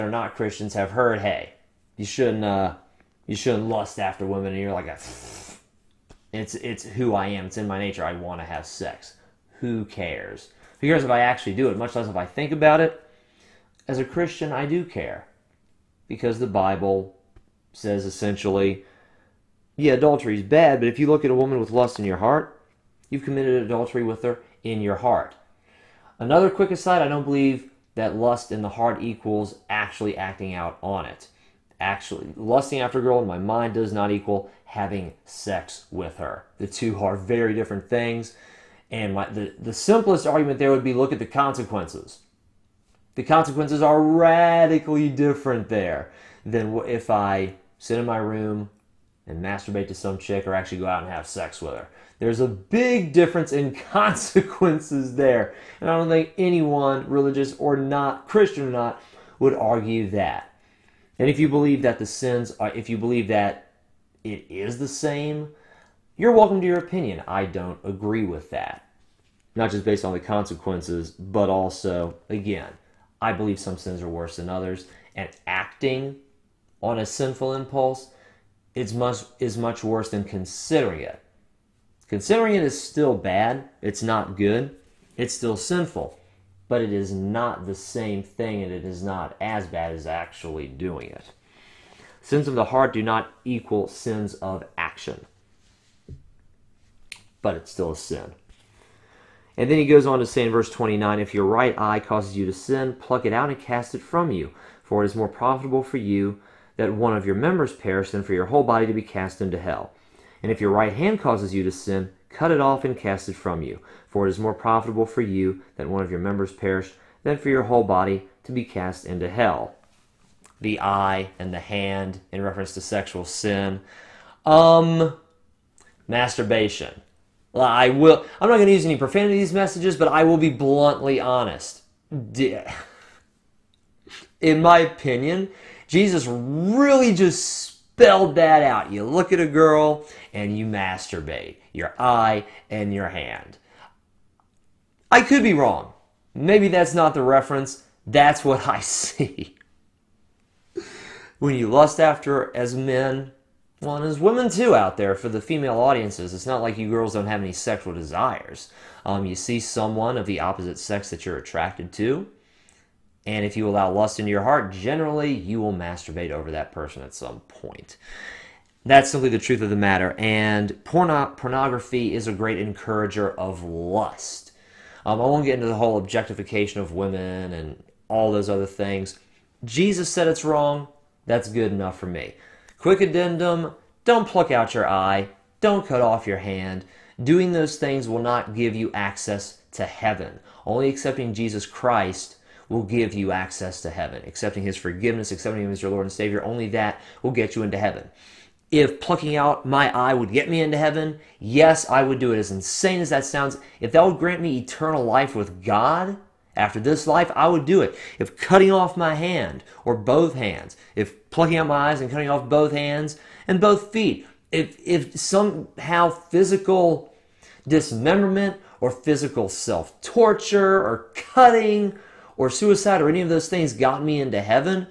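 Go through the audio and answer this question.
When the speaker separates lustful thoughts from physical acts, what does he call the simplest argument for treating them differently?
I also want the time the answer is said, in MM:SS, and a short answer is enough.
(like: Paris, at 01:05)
look at the consequences, at 00:40.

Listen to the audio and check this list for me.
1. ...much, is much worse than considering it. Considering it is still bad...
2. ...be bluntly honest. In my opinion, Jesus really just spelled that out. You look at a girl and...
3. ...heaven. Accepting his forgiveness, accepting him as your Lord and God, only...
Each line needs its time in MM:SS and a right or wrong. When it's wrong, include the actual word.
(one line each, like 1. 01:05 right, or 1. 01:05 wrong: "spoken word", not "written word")
1. 01:18 right
2. 02:10 right
3. 03:13 wrong: "Savior", not "God".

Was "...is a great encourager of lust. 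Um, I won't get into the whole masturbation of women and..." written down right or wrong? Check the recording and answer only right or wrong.
wrong.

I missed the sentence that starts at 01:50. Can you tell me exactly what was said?
And if your right hand causes you to sin, cut it off and cast it from you.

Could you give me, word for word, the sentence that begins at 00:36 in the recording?
The two are very different things.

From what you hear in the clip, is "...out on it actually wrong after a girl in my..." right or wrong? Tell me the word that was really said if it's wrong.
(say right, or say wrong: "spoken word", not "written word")
wrong: "lusting", not "wrong".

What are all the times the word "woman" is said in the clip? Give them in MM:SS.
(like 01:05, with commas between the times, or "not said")
00:21.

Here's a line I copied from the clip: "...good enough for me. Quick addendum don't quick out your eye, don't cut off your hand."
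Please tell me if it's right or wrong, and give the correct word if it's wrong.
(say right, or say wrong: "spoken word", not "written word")
wrong: "pluck", not "quick".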